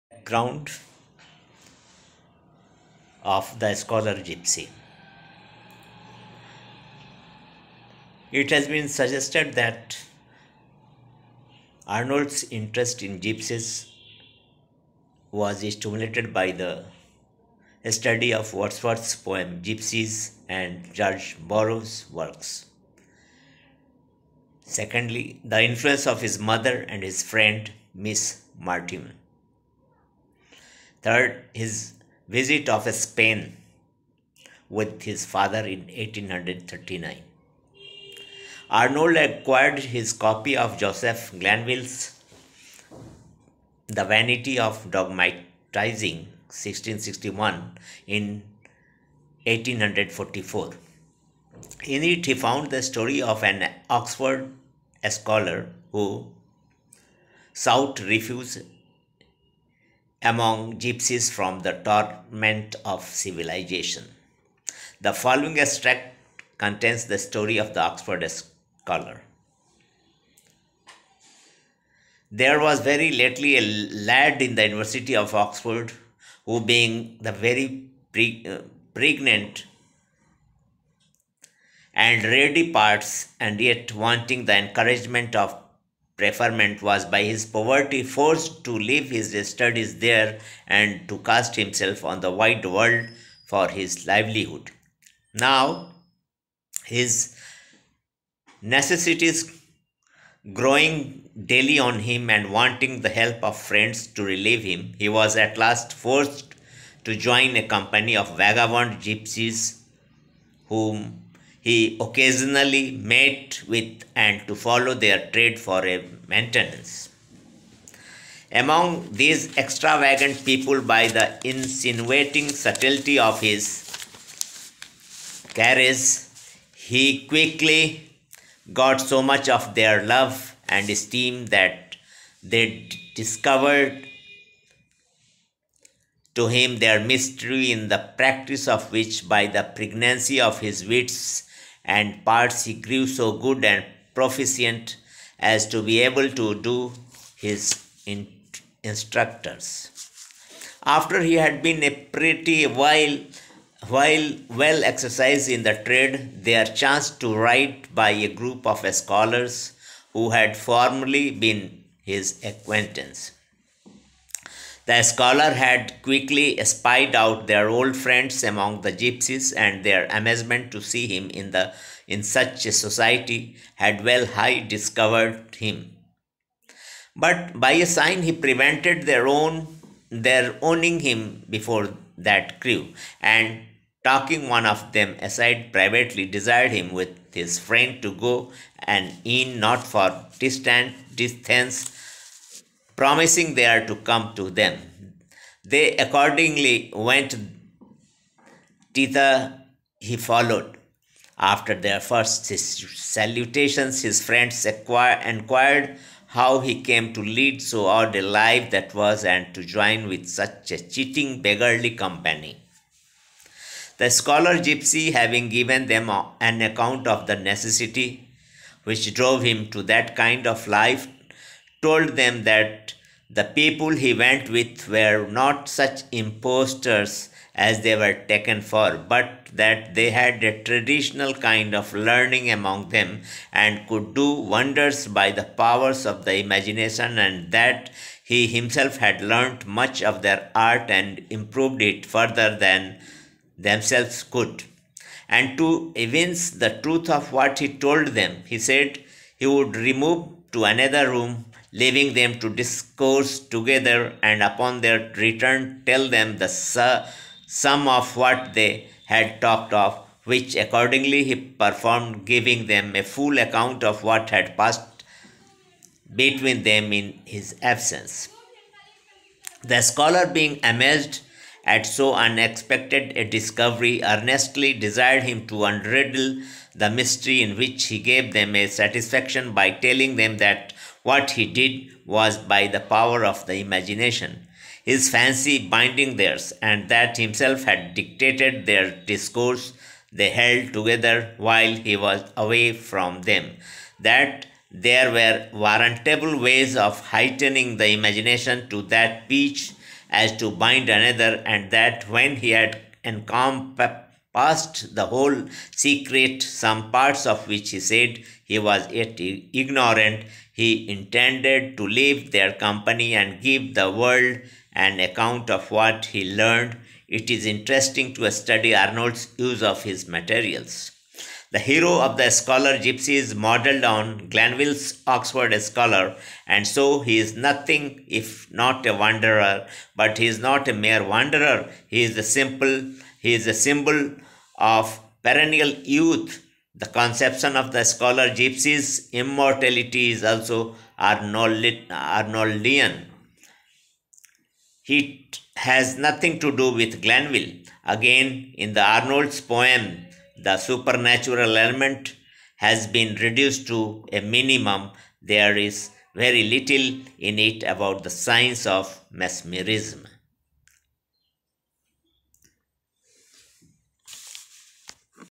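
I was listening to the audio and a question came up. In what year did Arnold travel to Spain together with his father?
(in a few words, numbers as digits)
1839.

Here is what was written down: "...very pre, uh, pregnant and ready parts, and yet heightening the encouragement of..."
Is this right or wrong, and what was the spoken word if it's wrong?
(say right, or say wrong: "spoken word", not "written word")
wrong: "wanting", not "heightening".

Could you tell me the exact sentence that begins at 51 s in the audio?
In it, he found the story of an Oxford scholar who sought refuge among gypsies from the torment of civilization.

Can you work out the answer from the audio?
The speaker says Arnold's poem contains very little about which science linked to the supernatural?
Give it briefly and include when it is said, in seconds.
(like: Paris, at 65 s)
mesmerism, at 359 s.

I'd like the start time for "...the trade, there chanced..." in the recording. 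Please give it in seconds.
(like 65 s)
155 s.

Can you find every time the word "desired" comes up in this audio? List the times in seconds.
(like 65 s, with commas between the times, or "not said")
186 s, 274 s.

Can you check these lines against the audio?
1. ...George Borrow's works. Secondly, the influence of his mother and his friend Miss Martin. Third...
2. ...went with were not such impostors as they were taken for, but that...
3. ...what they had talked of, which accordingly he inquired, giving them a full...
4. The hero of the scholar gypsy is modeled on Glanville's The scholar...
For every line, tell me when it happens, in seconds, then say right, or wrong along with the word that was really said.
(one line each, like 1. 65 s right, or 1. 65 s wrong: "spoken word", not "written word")
1. 20 s right
2. 224 s right
3. 258 s wrong: "performed", not "inquired"
4. 321 s wrong: "Oxford", not "The".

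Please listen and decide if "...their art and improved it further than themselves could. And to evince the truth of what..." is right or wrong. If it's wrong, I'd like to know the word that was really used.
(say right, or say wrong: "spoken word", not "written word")
right.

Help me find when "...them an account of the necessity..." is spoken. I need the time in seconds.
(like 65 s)
215 s.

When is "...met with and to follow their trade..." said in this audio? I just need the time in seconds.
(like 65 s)
112 s.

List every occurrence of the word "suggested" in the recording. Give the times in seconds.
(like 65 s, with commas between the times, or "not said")
8 s.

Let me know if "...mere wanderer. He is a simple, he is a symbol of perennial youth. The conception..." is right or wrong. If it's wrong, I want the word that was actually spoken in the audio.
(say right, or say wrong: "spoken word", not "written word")
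right.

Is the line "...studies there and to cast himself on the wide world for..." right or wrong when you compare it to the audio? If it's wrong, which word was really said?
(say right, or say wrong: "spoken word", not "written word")
right.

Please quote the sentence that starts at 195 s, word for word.
They accordingly went thither he followed.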